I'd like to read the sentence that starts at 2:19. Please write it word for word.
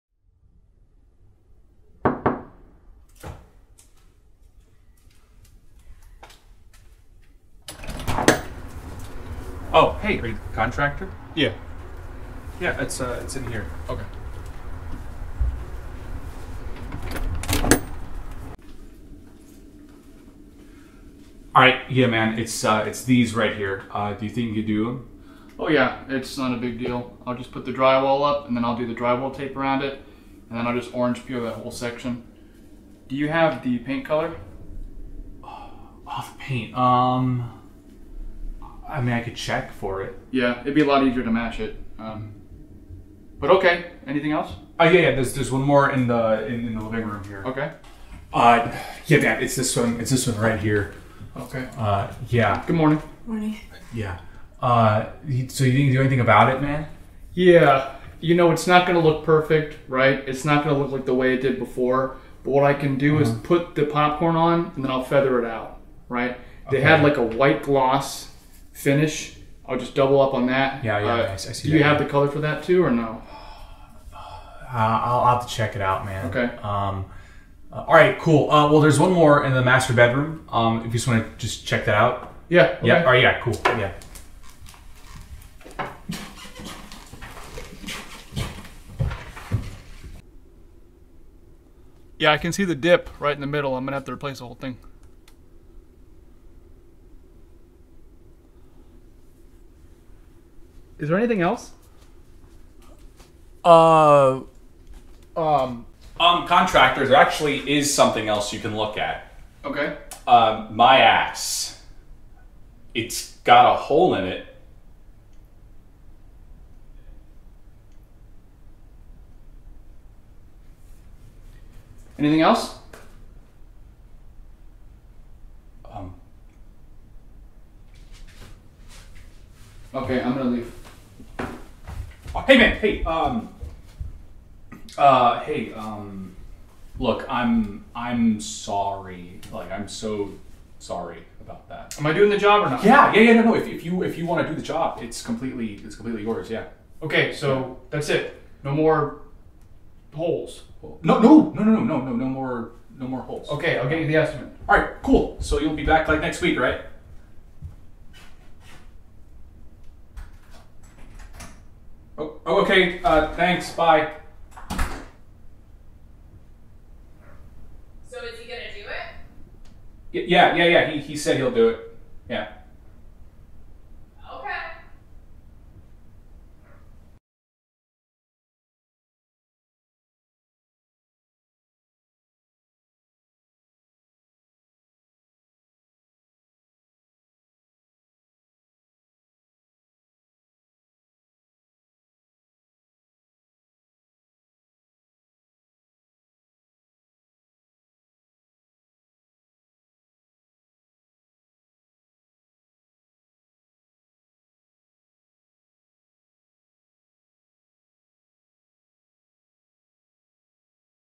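Like, I'm so sorry about that.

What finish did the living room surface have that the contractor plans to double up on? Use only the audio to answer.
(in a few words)
White gloss.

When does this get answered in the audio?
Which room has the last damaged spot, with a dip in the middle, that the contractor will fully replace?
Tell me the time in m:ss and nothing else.
1:19.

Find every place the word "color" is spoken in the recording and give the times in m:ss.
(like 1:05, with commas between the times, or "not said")
0:34, 1:12.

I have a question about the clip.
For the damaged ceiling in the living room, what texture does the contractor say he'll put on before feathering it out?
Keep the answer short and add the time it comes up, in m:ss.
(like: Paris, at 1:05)
Popcorn, at 1:03.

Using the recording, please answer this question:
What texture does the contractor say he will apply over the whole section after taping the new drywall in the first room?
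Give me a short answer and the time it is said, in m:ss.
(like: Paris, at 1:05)
Orange peel, at 0:30.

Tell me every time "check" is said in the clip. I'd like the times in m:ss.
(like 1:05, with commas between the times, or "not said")
0:39, 1:15, 1:21.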